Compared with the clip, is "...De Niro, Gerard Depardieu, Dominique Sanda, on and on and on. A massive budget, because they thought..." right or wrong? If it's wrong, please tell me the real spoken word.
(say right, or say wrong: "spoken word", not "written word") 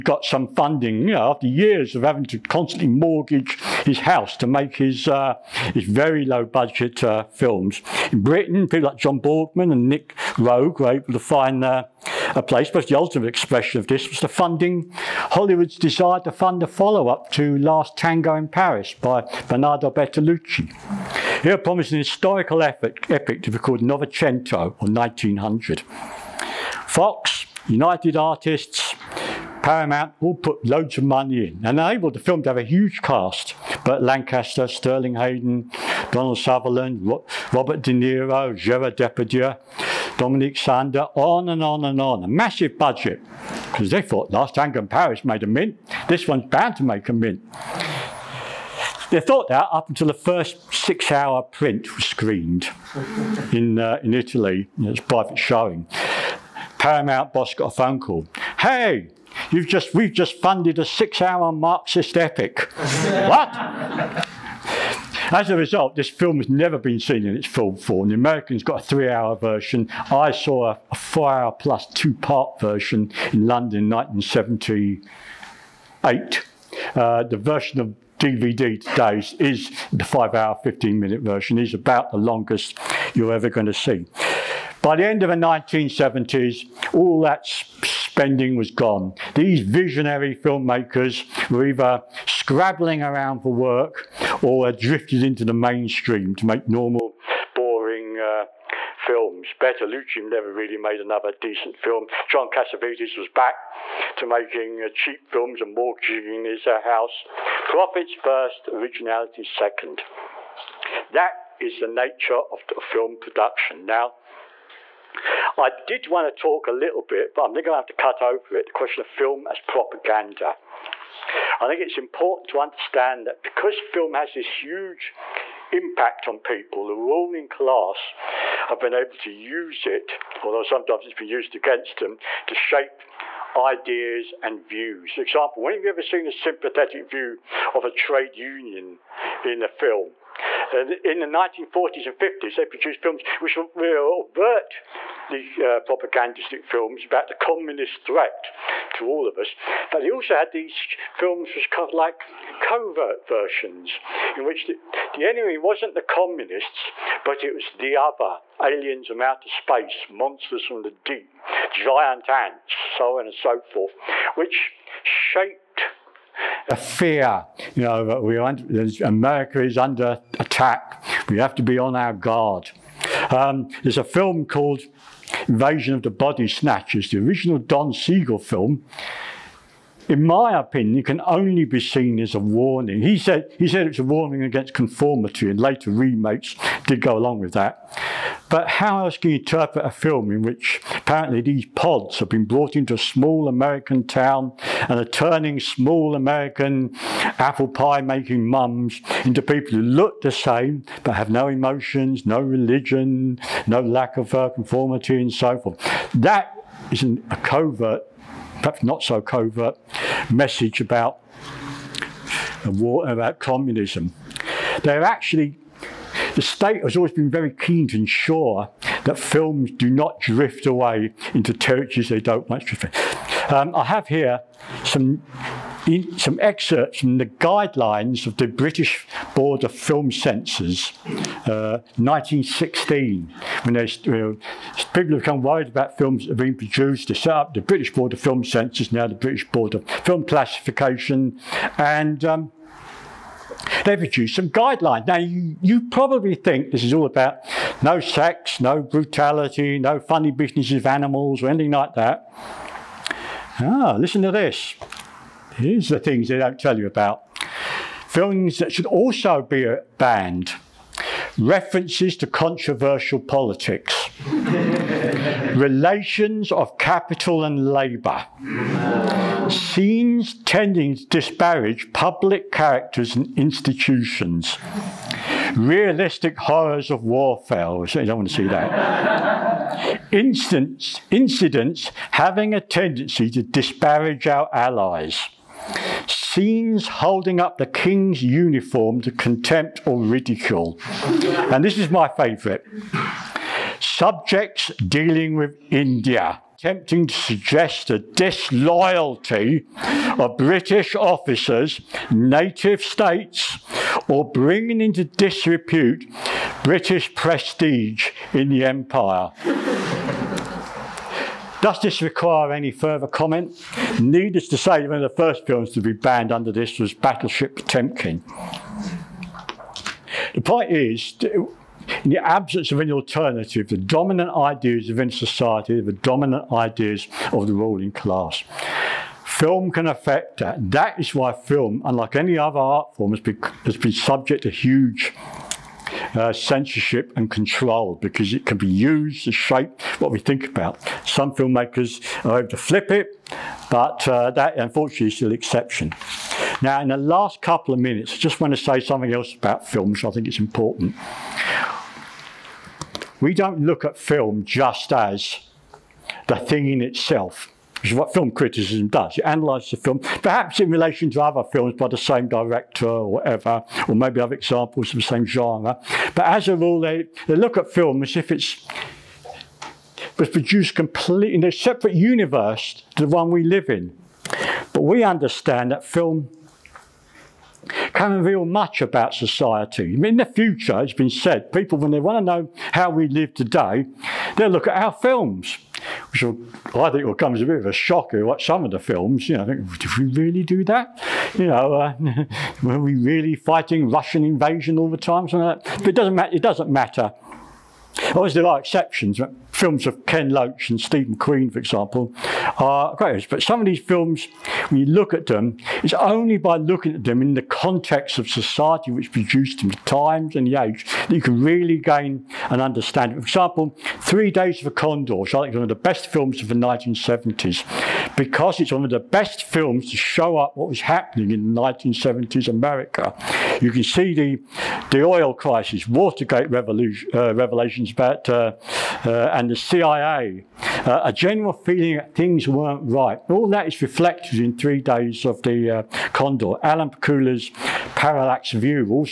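right.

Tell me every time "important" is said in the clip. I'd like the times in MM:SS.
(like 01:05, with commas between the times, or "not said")
02:01, 05:50.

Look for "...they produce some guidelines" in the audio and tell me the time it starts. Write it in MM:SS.
04:03.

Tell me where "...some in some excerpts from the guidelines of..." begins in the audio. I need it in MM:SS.
03:44.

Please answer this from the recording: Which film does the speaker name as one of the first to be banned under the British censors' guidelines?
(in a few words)
Battleship Potemkin.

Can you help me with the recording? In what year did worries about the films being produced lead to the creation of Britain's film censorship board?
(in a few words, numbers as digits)
1916.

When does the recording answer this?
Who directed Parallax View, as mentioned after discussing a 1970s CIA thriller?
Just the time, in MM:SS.
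07:16.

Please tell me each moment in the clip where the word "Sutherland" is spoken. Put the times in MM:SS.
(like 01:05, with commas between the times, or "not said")
00:36.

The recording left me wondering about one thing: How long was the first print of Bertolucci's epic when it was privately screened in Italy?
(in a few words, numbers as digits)
6 hours.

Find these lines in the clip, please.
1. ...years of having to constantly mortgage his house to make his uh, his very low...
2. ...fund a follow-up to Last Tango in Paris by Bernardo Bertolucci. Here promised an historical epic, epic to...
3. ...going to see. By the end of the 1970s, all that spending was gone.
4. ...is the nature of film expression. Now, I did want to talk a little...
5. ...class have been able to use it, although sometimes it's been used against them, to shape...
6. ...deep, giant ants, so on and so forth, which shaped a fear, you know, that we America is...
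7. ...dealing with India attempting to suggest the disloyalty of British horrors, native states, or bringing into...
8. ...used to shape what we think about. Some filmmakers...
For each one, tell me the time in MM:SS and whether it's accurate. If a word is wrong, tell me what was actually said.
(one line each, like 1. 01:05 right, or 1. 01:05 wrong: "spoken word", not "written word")
1. 00:01 right
2. 00:16 right
3. 01:23 right
4. 01:51 wrong: "production", not "expression"
5. 02:07 right
6. 02:40 right
7. 04:54 wrong: "officers", not "horrors"
8. 05:38 right.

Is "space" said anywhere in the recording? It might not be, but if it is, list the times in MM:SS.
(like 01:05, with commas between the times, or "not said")
02:39.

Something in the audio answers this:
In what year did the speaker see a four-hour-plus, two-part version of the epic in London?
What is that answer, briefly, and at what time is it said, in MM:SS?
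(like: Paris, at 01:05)
1978, at 01:13.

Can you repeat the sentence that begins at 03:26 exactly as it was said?
That is an, a covert perhaps not so covert message about the war, about communism.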